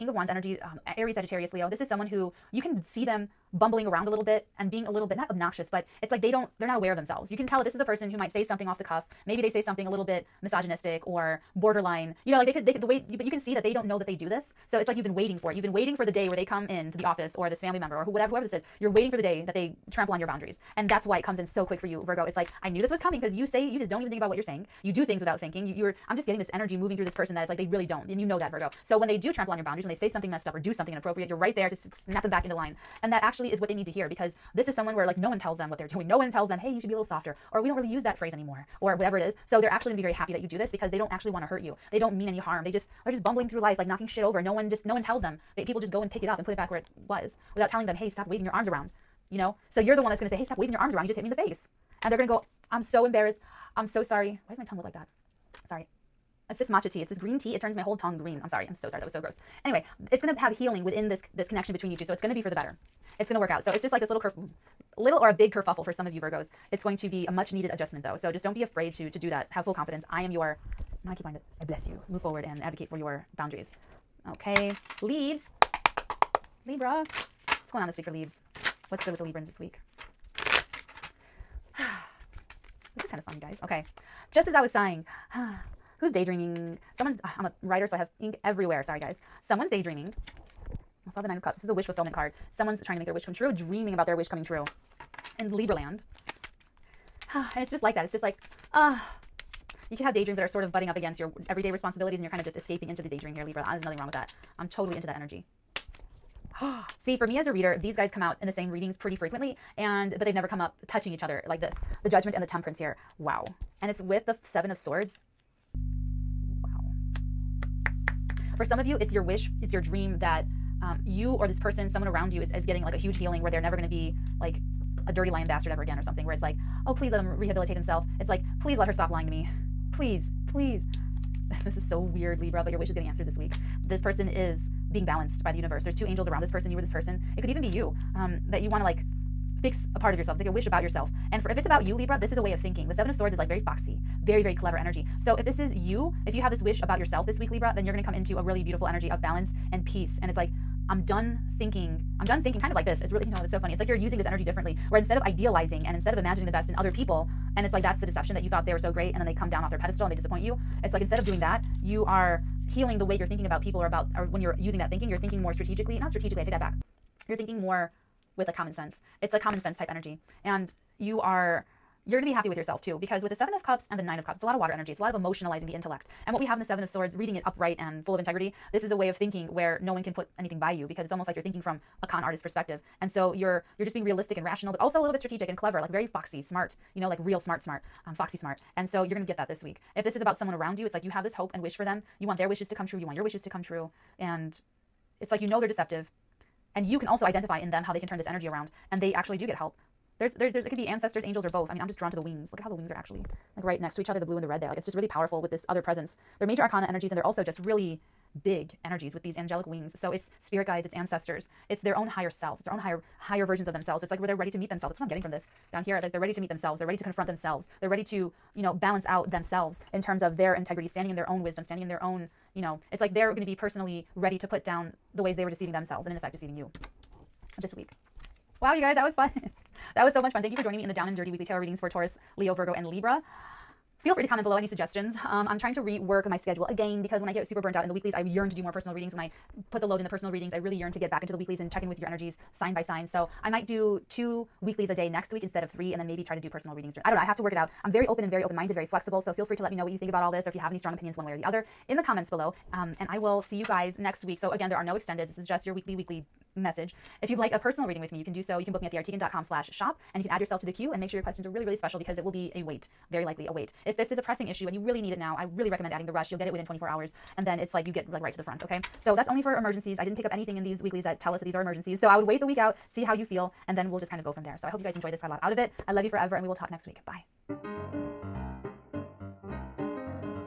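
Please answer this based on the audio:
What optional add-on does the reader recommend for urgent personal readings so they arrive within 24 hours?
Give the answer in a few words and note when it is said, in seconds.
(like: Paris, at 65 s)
The rush, at 266 s.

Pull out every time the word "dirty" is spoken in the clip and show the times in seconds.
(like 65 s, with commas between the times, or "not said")
125 s, 231 s.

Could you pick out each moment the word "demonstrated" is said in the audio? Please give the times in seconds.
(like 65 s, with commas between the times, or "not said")
not said.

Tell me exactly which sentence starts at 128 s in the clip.
It's like, Please let her stop lying to me.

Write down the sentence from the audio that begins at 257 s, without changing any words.
If you'd like a personal reading with me, you can do so.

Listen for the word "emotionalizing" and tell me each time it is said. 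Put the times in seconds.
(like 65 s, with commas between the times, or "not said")
175 s.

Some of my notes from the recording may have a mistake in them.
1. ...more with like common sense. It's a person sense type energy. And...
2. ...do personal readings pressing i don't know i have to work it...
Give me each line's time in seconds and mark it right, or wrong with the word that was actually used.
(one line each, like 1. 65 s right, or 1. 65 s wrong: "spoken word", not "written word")
1. 167 s wrong: "common", not "person"
2. 246 s wrong: "during", not "pressing".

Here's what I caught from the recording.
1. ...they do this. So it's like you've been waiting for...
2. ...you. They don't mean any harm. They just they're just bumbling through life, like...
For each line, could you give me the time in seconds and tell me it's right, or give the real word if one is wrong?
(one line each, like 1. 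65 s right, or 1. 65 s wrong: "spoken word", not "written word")
1. 14 s right
2. 41 s right.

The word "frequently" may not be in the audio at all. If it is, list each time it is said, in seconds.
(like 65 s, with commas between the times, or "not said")
109 s.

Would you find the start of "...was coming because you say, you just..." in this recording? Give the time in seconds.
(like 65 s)
22 s.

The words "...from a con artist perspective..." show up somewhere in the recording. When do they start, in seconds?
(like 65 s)
181 s.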